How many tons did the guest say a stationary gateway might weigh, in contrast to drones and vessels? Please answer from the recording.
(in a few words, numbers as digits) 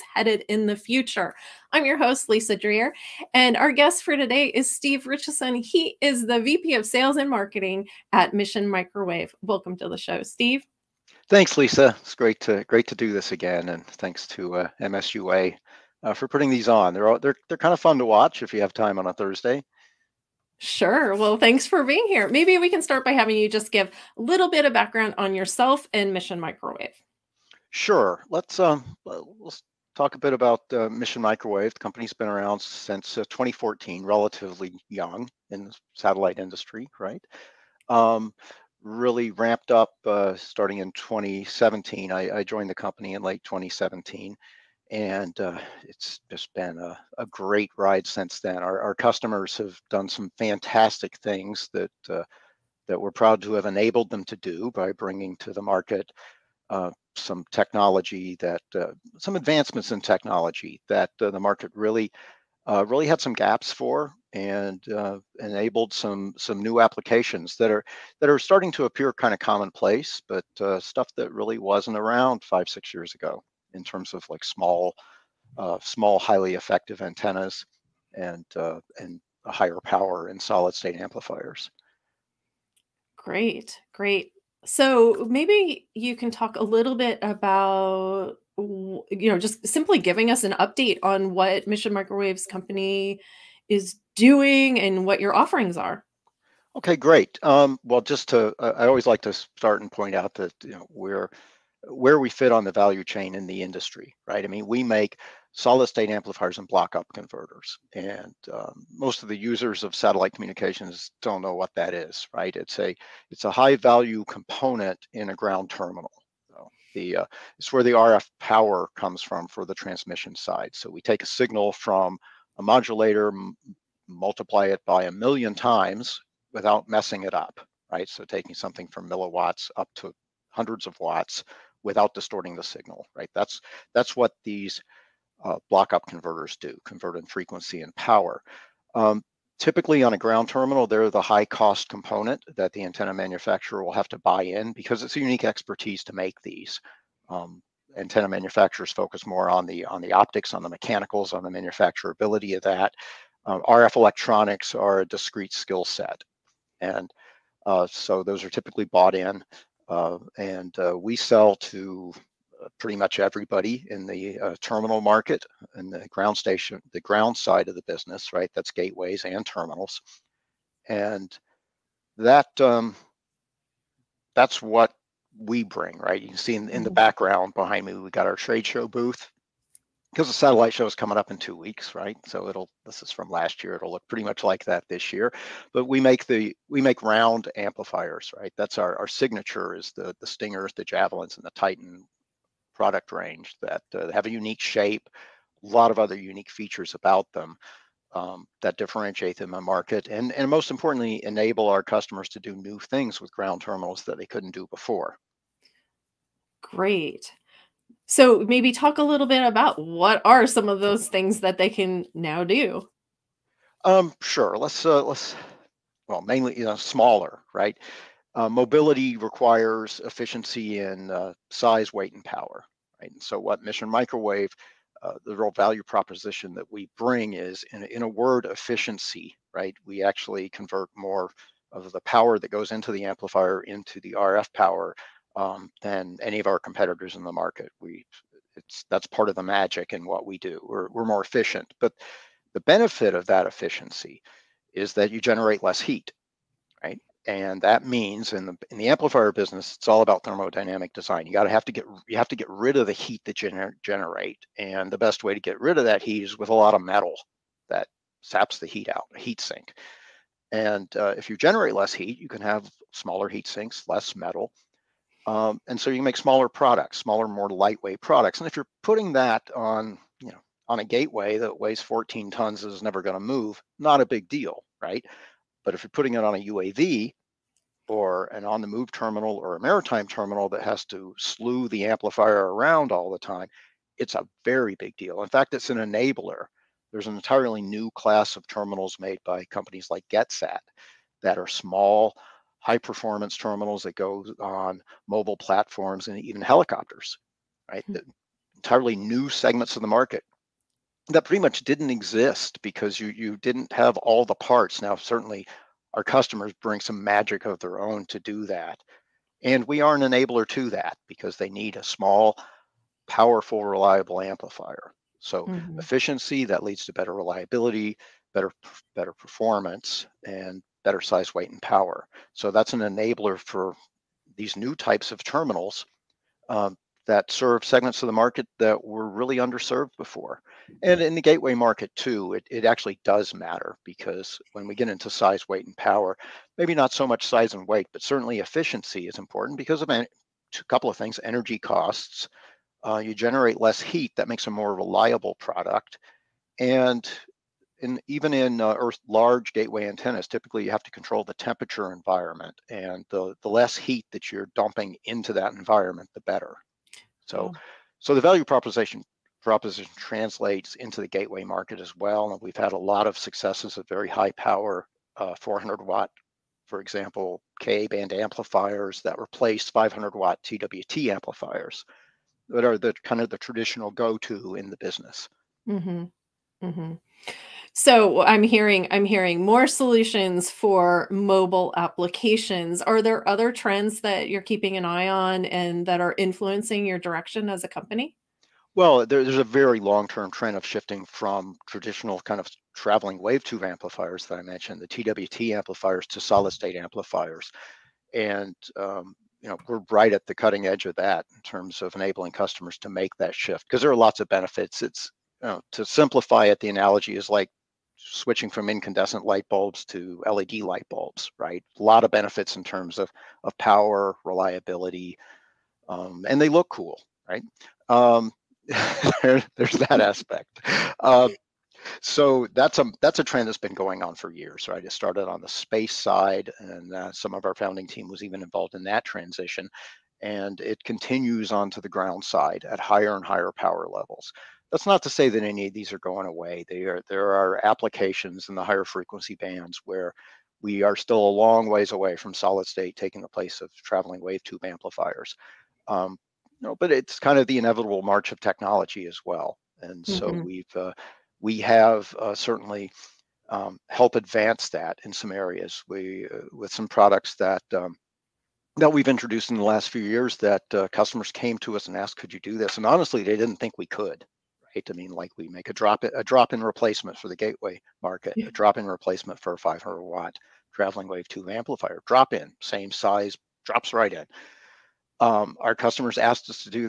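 14.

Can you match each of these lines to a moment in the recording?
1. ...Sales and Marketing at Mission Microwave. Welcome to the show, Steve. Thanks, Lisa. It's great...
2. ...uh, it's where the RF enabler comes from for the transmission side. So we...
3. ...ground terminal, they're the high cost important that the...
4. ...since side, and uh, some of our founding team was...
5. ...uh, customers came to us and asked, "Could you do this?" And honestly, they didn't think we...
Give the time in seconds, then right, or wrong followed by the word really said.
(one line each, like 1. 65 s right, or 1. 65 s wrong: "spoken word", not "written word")
1. 6 s right
2. 117 s wrong: "power", not "enabler"
3. 140 s wrong: "component", not "important"
4. 425 s wrong: "space", not "since"
5. 460 s right.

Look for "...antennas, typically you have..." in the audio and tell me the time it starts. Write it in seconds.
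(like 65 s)
349 s.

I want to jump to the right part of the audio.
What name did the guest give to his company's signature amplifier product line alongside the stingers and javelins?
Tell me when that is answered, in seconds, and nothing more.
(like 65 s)
191 s.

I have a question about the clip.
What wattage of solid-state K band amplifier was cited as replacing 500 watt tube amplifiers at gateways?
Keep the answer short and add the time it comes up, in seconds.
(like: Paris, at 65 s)
400 watt, at 365 s.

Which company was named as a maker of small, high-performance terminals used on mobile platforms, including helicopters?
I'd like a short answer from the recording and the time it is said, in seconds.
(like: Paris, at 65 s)
GetSat, at 290 s.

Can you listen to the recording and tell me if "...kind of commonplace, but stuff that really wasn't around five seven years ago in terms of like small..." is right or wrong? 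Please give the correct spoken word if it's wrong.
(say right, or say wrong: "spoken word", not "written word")
wrong: "six", not "seven".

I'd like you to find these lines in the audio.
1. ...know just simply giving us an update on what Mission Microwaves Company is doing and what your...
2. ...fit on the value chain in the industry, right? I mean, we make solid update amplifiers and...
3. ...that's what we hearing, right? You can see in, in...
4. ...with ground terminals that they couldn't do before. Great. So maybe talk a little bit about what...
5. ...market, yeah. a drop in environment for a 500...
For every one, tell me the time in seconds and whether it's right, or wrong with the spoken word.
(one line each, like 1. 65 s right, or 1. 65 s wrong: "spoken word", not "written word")
1. 89 s right
2. 102 s wrong: "state", not "update"
3. 174 s wrong: "bring", not "hearing"
4. 203 s right
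5. 468 s wrong: "replacement", not "environment".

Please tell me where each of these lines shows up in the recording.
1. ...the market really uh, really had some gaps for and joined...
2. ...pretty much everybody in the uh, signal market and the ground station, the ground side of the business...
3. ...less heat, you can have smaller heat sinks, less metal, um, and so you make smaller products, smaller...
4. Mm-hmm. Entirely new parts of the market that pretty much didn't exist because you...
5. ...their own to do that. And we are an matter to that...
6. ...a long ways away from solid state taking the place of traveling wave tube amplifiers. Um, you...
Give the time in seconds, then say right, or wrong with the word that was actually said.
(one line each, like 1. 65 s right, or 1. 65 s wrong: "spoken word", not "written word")
1. 61 s wrong: "enabled", not "joined"
2. 162 s wrong: "terminal", not "signal"
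3. 261 s right
4. 297 s wrong: "segments", not "parts"
5. 307 s wrong: "enabler", not "matter"
6. 441 s right.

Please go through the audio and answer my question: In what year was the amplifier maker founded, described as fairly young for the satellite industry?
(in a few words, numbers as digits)
2014.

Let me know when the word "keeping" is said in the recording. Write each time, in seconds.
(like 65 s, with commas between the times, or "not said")
384 s.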